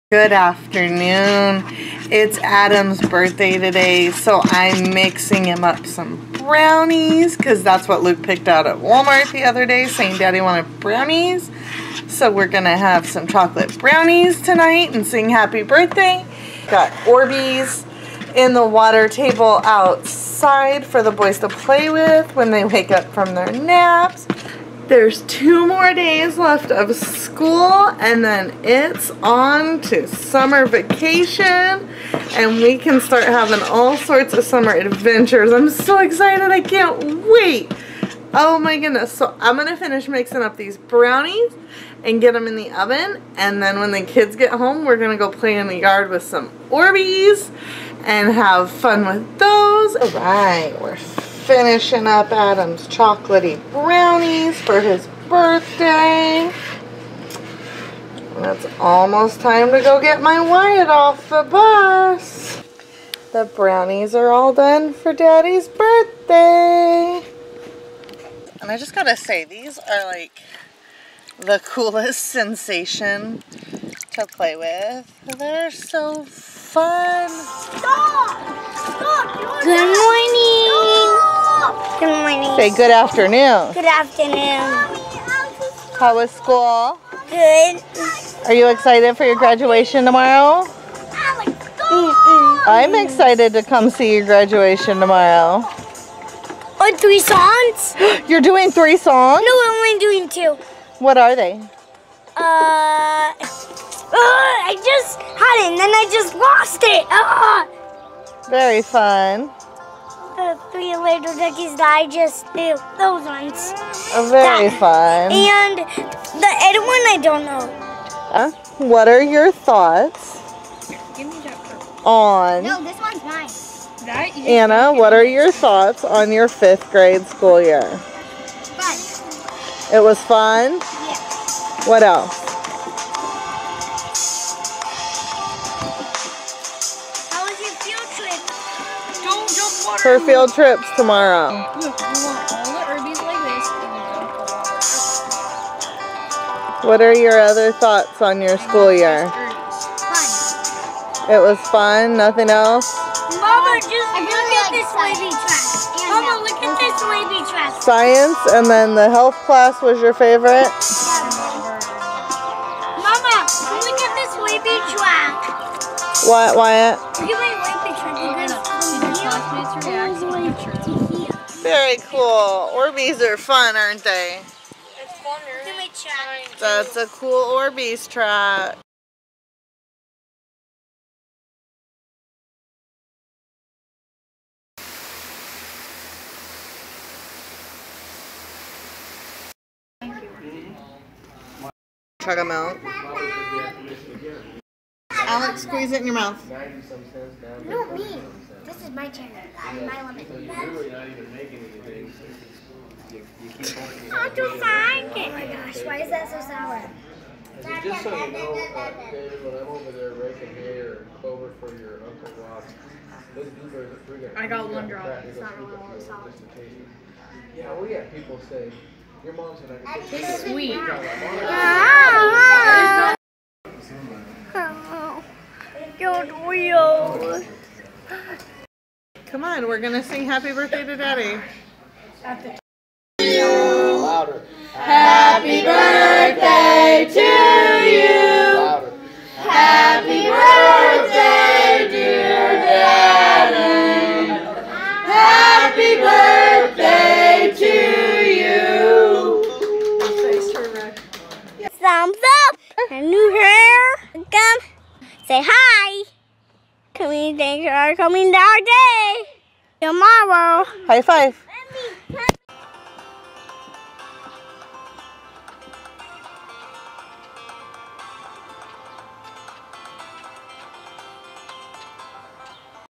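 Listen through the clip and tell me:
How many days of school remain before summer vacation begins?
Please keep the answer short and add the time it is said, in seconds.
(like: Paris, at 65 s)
2, at 25 s.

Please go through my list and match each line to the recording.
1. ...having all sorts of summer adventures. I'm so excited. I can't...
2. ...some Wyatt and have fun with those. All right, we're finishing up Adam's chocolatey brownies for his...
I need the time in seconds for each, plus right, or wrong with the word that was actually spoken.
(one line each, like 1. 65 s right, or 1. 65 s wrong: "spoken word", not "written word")
1. 33 s right
2. 46 s wrong: "Orbeez", not "Wyatt".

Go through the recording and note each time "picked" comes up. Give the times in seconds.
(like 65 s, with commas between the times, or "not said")
8 s.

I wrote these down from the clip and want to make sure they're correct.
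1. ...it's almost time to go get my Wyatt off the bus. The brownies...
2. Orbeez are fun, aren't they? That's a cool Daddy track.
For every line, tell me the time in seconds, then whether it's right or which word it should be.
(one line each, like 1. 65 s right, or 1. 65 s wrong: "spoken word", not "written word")
1. 58 s right
2. 172 s wrong: "Orbeez", not "Daddy".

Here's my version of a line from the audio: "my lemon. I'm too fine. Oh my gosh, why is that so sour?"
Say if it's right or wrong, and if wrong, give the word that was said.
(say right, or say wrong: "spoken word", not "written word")
right.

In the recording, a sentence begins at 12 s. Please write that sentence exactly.
So we're going to have some chocolate brownies tonight and sing happy birthday.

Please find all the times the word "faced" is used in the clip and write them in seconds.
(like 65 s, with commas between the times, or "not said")
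not said.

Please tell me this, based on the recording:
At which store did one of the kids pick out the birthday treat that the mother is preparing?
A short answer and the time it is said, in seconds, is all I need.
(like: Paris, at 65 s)
Walmart, at 8 s.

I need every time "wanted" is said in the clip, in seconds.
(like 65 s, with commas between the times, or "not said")
10 s.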